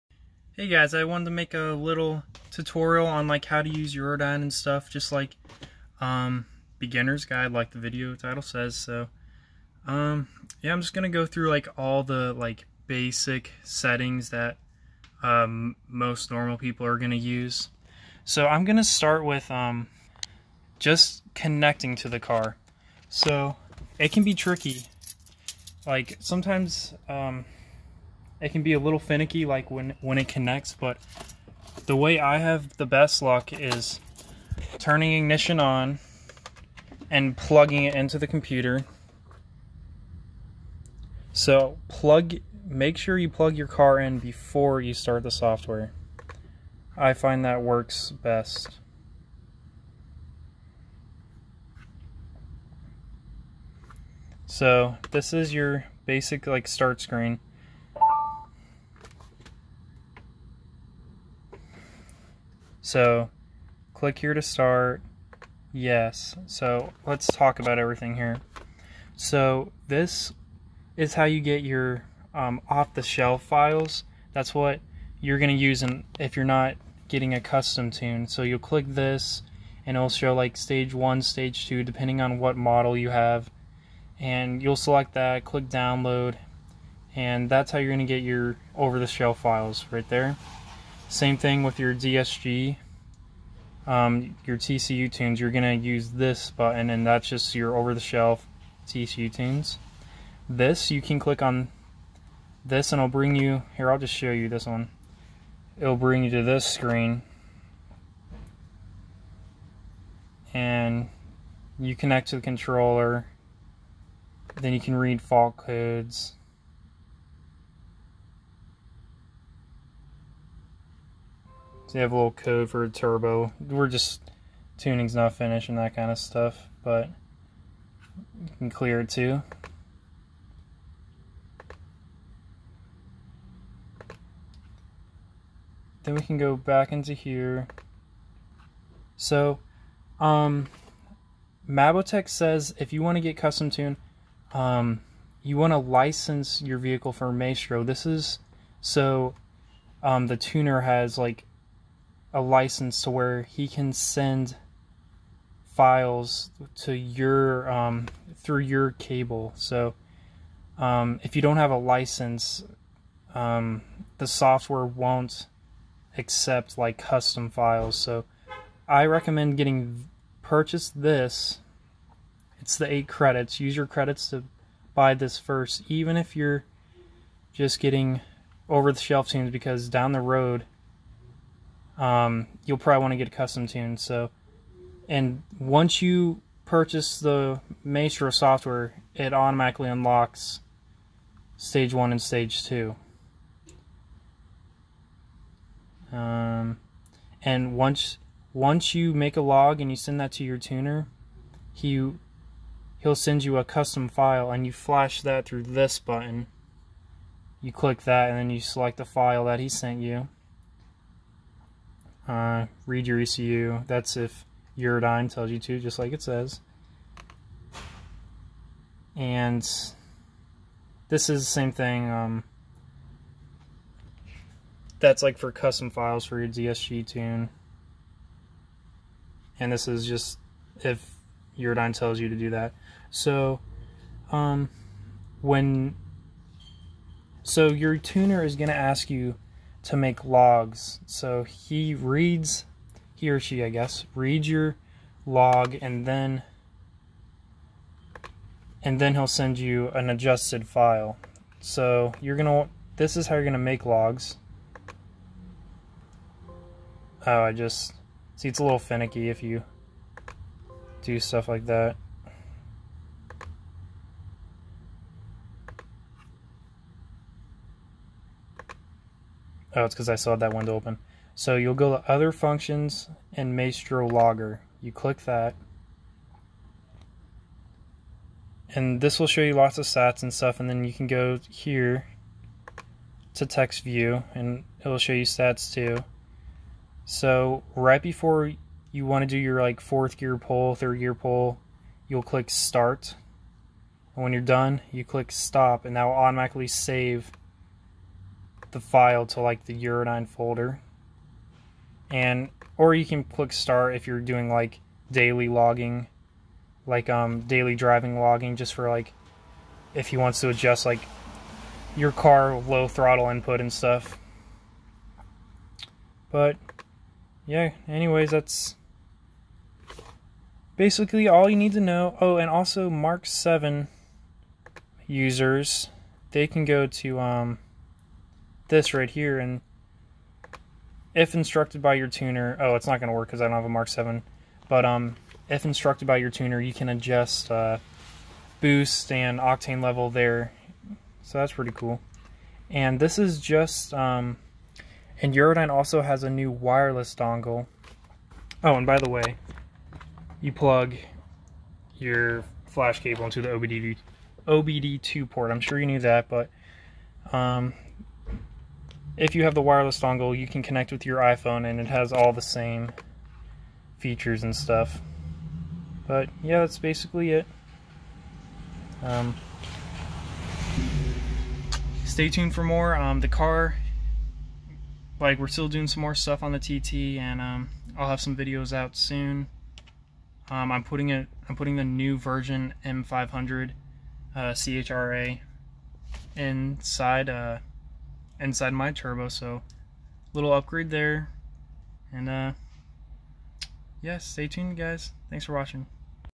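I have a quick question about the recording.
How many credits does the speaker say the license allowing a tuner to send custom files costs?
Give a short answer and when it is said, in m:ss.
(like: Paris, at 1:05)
8, at 2:52.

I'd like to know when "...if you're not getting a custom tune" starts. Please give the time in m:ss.
1:16.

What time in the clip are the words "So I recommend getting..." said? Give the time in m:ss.
2:47.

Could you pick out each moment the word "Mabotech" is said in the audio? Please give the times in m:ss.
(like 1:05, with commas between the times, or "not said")
2:21.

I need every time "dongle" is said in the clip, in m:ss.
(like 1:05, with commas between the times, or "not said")
5:47, 5:59.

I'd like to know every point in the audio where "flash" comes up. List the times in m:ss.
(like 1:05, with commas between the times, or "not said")
3:24, 5:52.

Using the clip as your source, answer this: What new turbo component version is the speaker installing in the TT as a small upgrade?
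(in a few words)
M500 CHRA.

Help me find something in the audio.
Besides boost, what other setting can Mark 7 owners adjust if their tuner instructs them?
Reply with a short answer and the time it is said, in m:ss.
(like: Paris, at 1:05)
Octane level, at 5:39.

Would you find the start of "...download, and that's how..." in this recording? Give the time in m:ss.
1:25.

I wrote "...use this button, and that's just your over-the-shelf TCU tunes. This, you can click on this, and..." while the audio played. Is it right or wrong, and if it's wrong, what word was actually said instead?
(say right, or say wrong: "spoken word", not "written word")
right.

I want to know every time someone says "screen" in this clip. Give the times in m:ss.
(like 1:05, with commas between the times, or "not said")
0:56, 1:46.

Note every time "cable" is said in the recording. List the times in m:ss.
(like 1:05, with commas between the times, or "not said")
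2:38, 5:53.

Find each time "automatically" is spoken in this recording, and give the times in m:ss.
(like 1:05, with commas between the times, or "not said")
3:09, 4:56.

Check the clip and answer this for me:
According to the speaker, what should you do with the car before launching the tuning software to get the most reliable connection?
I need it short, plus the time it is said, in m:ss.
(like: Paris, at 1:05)
Plug your car in, at 0:43.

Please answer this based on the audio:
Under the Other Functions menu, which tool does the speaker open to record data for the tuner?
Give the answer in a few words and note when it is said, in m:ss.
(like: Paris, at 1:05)
Maestro Logger, at 4:33.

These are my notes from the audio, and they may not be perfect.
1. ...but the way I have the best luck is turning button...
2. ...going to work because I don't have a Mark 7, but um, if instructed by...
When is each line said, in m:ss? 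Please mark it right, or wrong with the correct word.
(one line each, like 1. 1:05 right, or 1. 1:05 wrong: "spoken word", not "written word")
1. 0:30 wrong: "ignition", not "button"
2. 5:32 right.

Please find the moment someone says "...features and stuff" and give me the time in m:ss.
6:03.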